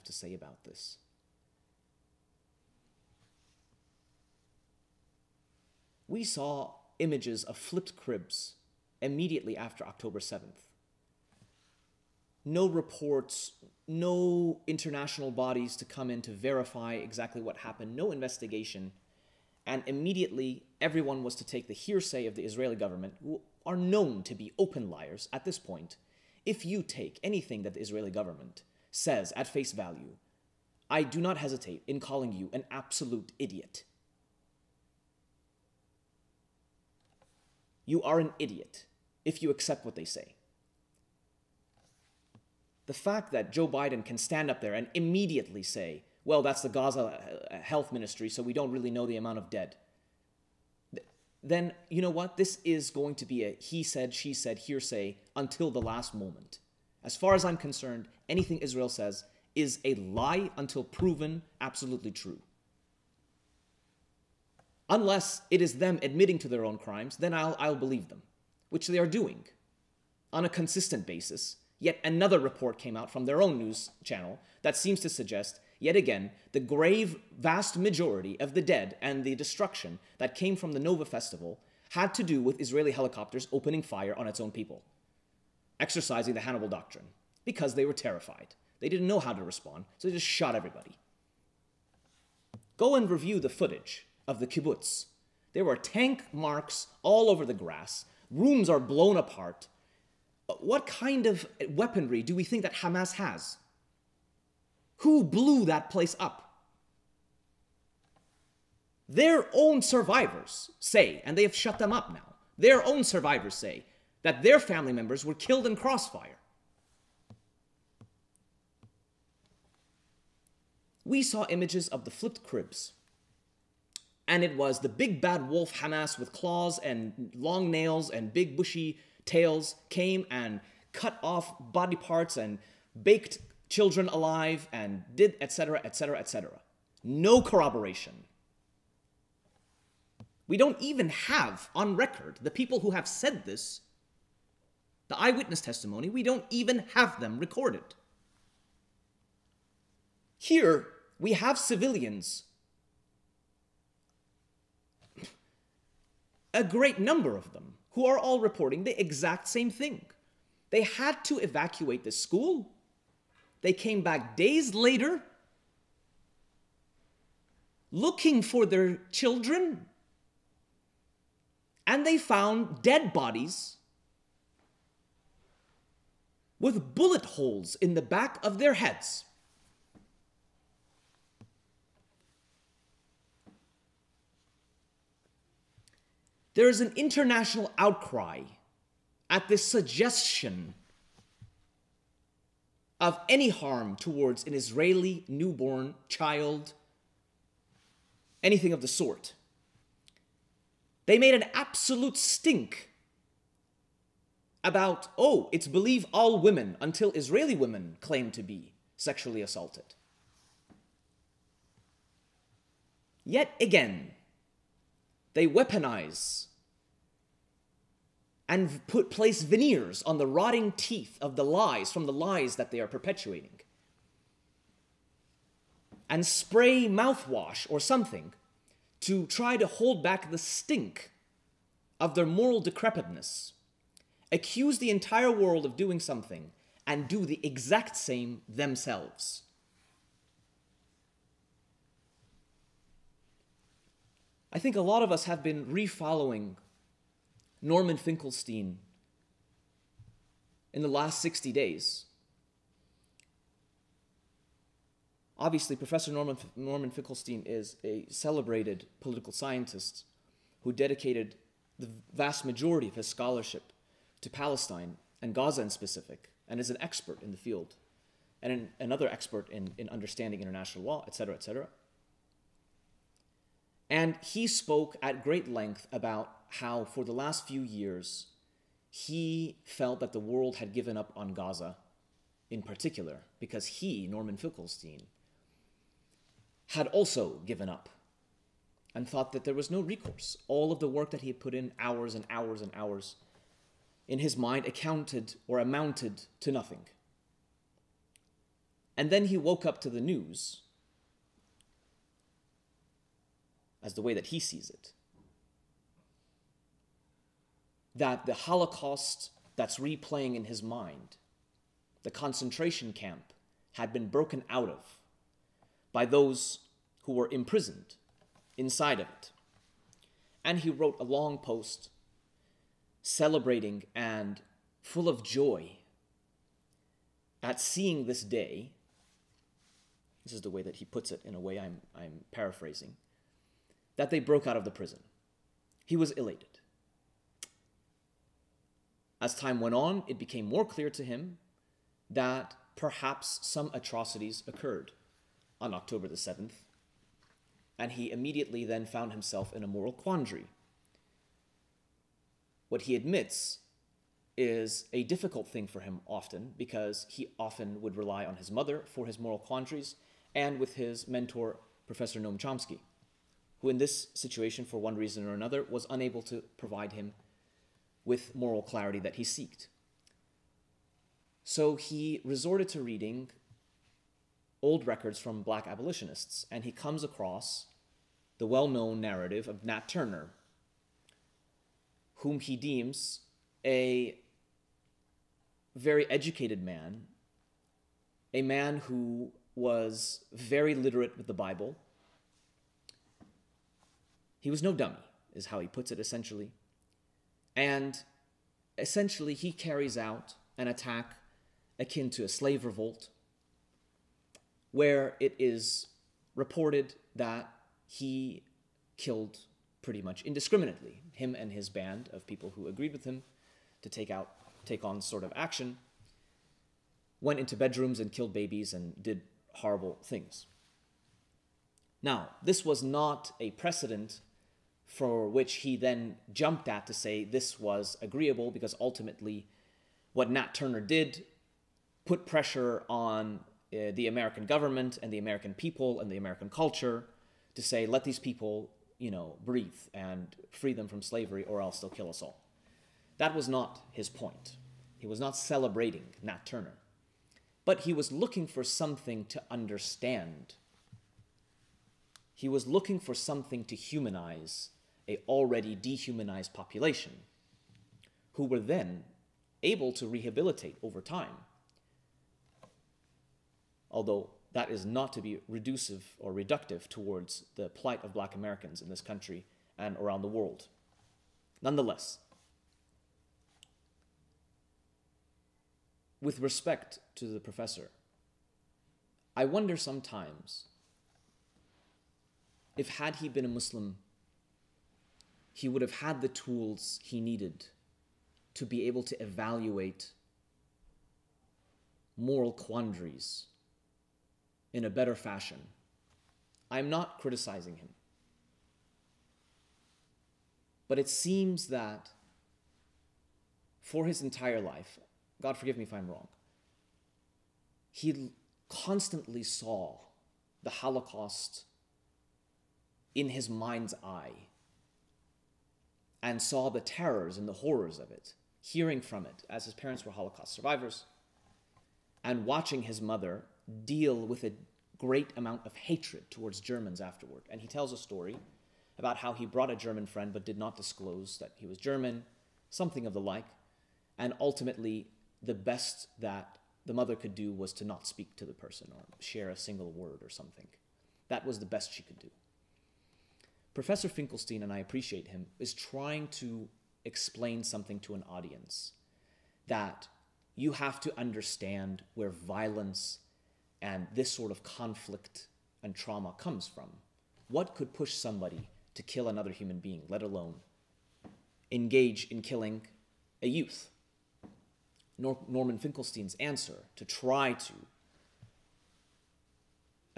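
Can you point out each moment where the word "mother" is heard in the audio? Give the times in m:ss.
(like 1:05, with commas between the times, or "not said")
5:58, 8:43, 8:56.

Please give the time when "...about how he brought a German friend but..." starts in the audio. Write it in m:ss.
8:48.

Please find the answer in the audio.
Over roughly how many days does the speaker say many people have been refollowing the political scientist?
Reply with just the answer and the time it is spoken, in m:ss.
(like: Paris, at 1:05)
60, at 4:11.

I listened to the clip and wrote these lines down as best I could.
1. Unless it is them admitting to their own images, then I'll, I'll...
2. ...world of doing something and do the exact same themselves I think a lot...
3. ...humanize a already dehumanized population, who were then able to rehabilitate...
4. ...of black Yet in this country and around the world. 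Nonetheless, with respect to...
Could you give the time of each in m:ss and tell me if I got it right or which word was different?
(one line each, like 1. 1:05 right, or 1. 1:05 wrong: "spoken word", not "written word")
1. 1:04 wrong: "crimes", not "images"
2. 3:55 right
3. 7:33 right
4. 7:48 wrong: "Americans", not "Yet".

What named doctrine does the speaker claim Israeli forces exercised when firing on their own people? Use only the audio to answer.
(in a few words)
Hannibal Doctrine.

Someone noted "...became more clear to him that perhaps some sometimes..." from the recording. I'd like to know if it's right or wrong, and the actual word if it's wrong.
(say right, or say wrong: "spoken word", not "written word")
wrong: "atrocities", not "sometimes".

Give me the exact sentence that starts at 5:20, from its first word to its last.
And he wrote a long post celebrating and full of joy at seeing this day.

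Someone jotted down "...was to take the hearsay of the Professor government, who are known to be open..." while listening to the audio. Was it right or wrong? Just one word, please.
wrong.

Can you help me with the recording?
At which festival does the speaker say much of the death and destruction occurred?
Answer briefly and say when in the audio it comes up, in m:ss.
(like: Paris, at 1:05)
Nova festival, at 1:20.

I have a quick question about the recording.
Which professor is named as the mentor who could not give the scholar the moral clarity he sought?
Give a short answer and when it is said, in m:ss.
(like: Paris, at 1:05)
Noam Chomsky, at 6:02.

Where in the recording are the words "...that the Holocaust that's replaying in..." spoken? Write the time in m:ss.
5:08.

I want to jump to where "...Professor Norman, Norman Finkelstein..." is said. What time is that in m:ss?
4:15.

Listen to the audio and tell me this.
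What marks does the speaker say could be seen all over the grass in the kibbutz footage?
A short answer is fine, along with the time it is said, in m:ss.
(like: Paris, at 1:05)
Tank marks, at 1:35.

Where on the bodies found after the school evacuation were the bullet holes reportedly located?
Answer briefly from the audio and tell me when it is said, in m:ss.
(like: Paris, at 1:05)
Back of their heads, at 2:58.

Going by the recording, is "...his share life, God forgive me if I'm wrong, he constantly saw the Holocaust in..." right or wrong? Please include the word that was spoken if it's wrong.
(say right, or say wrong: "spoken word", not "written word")
wrong: "entire", not "share".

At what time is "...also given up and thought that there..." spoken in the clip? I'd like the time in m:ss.
4:46.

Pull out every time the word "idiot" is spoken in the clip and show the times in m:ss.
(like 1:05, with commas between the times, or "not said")
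0:33, 0:38.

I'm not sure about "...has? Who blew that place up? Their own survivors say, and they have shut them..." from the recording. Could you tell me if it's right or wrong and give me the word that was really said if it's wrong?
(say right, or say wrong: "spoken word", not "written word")
right.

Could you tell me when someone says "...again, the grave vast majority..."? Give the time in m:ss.
1:15.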